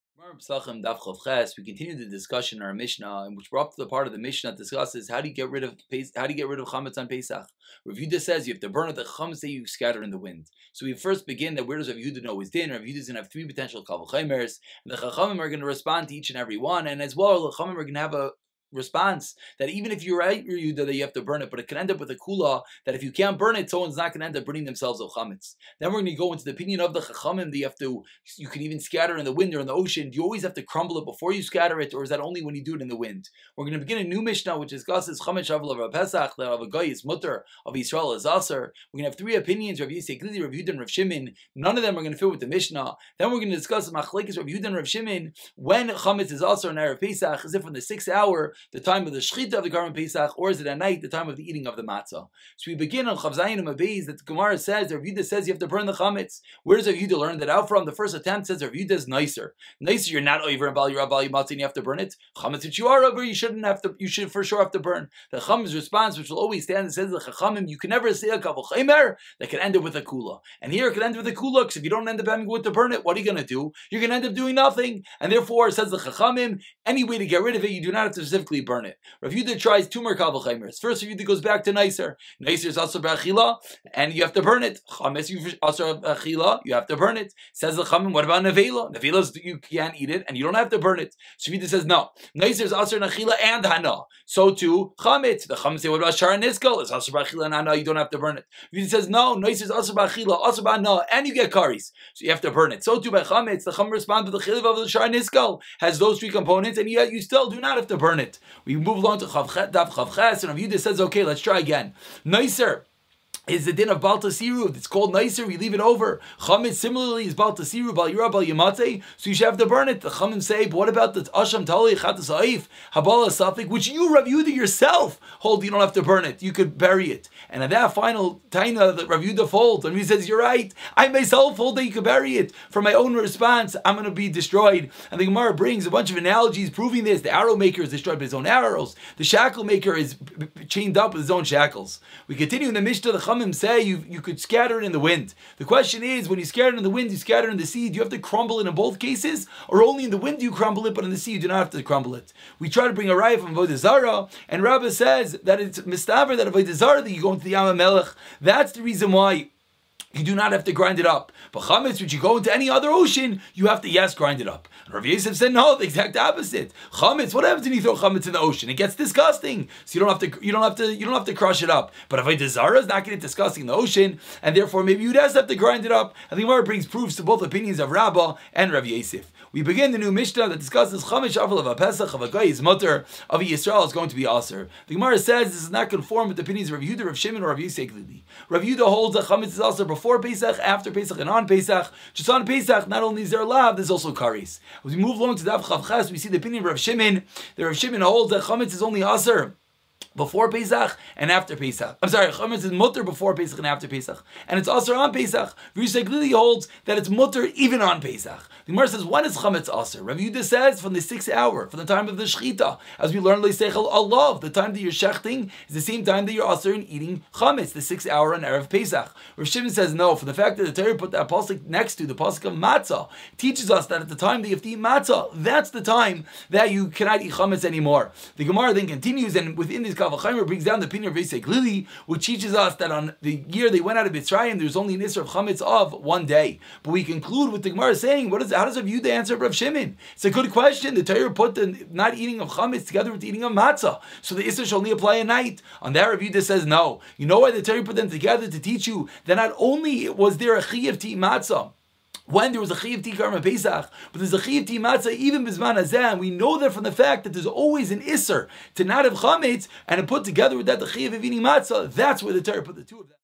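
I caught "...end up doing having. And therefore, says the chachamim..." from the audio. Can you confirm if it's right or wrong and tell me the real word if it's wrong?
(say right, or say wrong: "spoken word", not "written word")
wrong: "nothing", not "having".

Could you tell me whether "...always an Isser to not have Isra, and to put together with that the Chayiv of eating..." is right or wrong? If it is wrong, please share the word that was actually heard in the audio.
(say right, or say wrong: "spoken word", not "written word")
wrong: "Chametz", not "Isra".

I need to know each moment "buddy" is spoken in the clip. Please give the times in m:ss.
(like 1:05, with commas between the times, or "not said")
not said.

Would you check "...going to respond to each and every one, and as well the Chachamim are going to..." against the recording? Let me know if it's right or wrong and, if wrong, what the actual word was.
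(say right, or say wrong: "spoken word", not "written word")
right.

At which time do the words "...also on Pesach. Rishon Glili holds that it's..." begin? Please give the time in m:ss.
3:24.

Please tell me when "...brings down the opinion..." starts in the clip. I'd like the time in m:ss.
3:50.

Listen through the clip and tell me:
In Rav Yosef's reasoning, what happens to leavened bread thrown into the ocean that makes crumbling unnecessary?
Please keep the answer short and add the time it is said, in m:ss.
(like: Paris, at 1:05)
It gets disgusting, at 2:48.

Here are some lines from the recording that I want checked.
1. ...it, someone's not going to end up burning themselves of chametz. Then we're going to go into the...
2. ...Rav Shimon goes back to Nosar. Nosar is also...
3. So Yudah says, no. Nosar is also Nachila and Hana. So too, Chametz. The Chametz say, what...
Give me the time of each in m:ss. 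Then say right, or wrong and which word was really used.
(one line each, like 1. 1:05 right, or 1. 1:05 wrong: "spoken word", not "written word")
1. 0:23 right
2. 1:21 wrong: "Yudah", not "Shimon"
3. 1:31 right.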